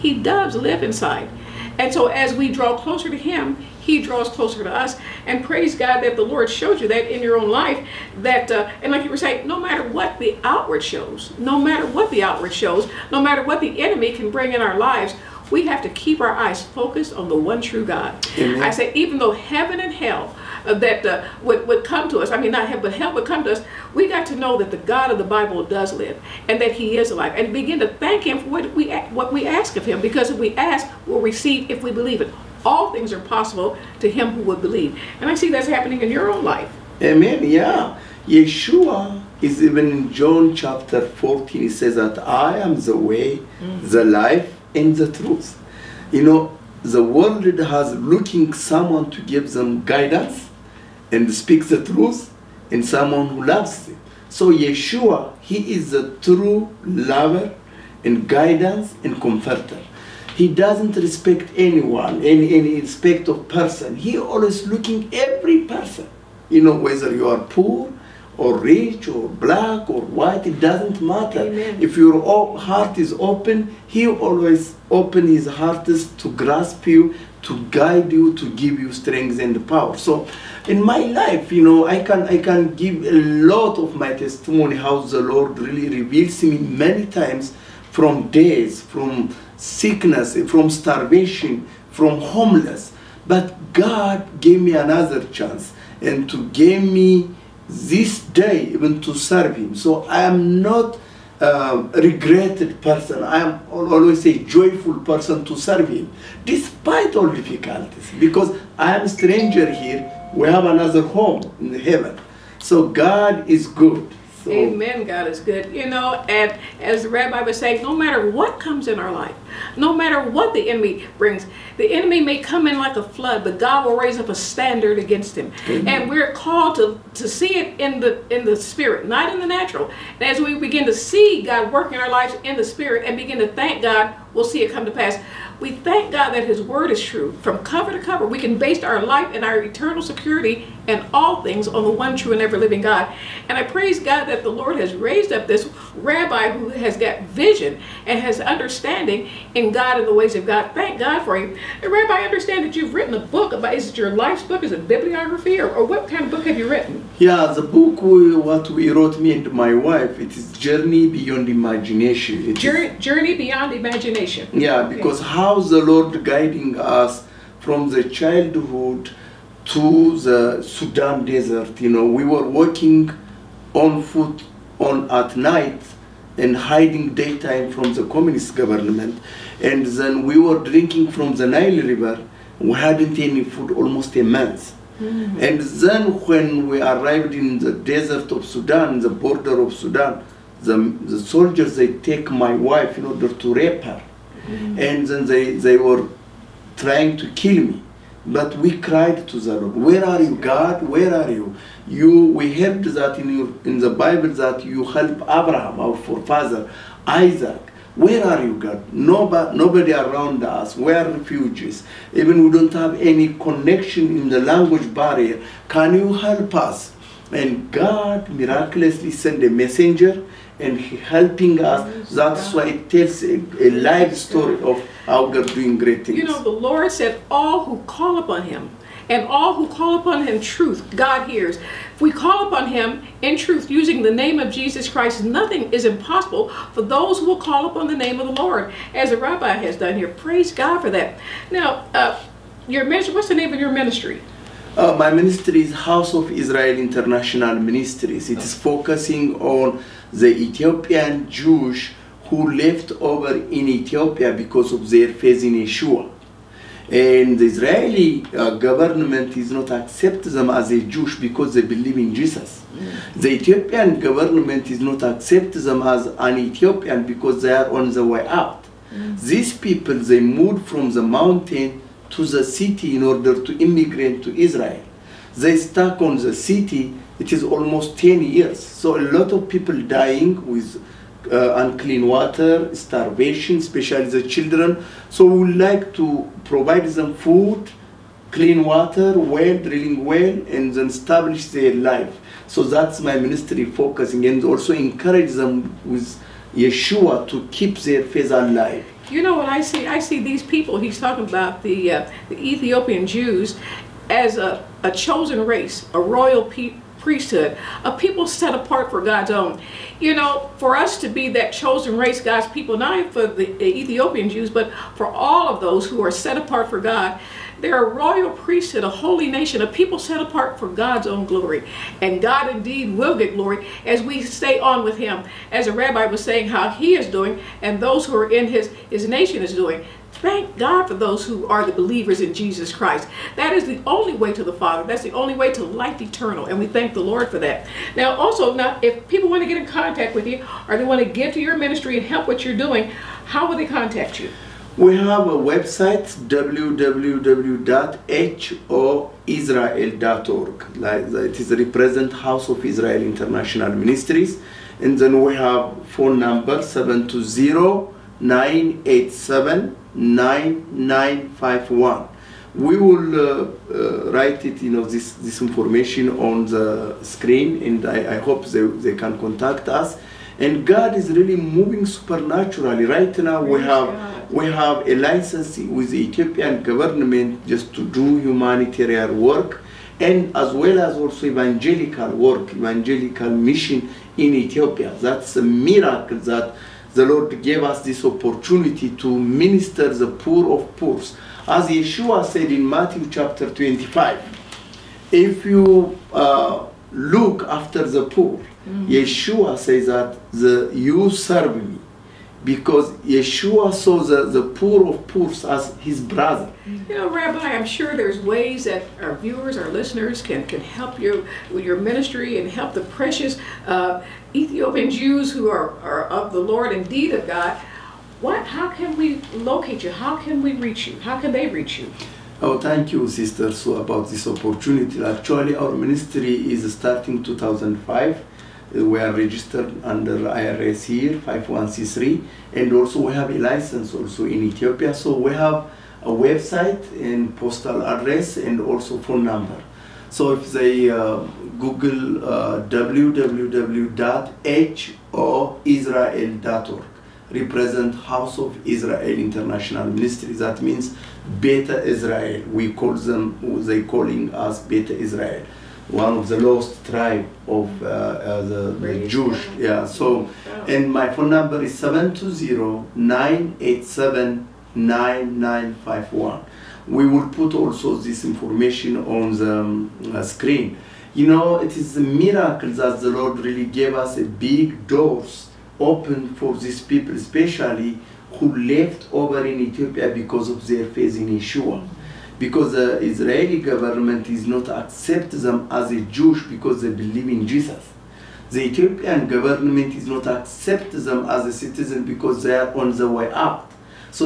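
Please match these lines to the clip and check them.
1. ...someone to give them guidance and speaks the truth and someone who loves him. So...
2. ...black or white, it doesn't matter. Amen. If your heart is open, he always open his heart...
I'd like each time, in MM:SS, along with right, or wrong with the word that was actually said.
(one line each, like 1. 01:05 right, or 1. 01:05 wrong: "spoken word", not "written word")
1. 00:48 right
2. 01:09 right.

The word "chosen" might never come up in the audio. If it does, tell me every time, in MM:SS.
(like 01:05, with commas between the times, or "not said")
05:04, 05:11.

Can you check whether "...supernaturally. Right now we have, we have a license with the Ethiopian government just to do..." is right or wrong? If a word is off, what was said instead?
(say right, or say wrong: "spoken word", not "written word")
right.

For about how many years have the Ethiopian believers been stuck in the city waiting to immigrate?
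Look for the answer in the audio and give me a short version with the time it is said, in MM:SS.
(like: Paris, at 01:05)
10 years, at 04:37.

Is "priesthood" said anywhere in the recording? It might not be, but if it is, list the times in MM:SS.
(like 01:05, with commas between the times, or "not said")
05:07, 05:18.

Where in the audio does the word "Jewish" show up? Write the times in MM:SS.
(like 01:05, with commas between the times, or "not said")
04:11, 04:20, 07:39, 08:06.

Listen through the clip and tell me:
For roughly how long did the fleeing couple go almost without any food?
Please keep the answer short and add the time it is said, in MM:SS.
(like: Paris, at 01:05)
a month, at 03:03.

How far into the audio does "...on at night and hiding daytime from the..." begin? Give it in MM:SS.
02:54.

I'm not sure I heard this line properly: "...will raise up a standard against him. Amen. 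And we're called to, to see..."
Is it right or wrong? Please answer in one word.
right.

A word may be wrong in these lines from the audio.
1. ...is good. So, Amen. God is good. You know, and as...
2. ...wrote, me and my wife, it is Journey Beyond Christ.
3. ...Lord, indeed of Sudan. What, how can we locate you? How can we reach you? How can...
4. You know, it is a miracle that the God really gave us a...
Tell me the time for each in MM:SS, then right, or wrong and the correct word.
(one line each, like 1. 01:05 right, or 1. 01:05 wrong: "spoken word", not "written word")
1. 01:53 right
2. 02:38 wrong: "Imagination", not "Christ"
3. 06:56 wrong: "God", not "Sudan"
4. 07:51 wrong: "Lord", not "God".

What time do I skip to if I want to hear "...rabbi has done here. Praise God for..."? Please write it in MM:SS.
03:59.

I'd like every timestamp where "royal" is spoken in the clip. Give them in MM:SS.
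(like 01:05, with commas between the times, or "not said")
05:05, 05:17.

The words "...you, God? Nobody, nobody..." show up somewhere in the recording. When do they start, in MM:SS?
03:28.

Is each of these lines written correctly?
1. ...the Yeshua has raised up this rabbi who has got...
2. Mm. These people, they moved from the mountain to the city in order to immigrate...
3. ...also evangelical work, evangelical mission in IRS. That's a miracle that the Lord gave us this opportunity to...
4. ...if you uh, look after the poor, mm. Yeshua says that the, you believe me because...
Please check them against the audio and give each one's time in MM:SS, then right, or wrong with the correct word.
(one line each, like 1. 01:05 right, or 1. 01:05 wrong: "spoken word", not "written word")
1. 02:24 wrong: "Lord", not "Yeshua"
2. 04:28 right
3. 06:20 wrong: "Ethiopia", not "IRS"
4. 06:35 wrong: "serve", not "believe".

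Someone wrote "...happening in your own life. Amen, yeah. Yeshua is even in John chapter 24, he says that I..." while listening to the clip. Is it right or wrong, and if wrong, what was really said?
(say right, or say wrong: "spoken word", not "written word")
wrong: "14", not "24".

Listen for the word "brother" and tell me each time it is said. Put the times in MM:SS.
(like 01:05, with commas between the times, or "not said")
06:46.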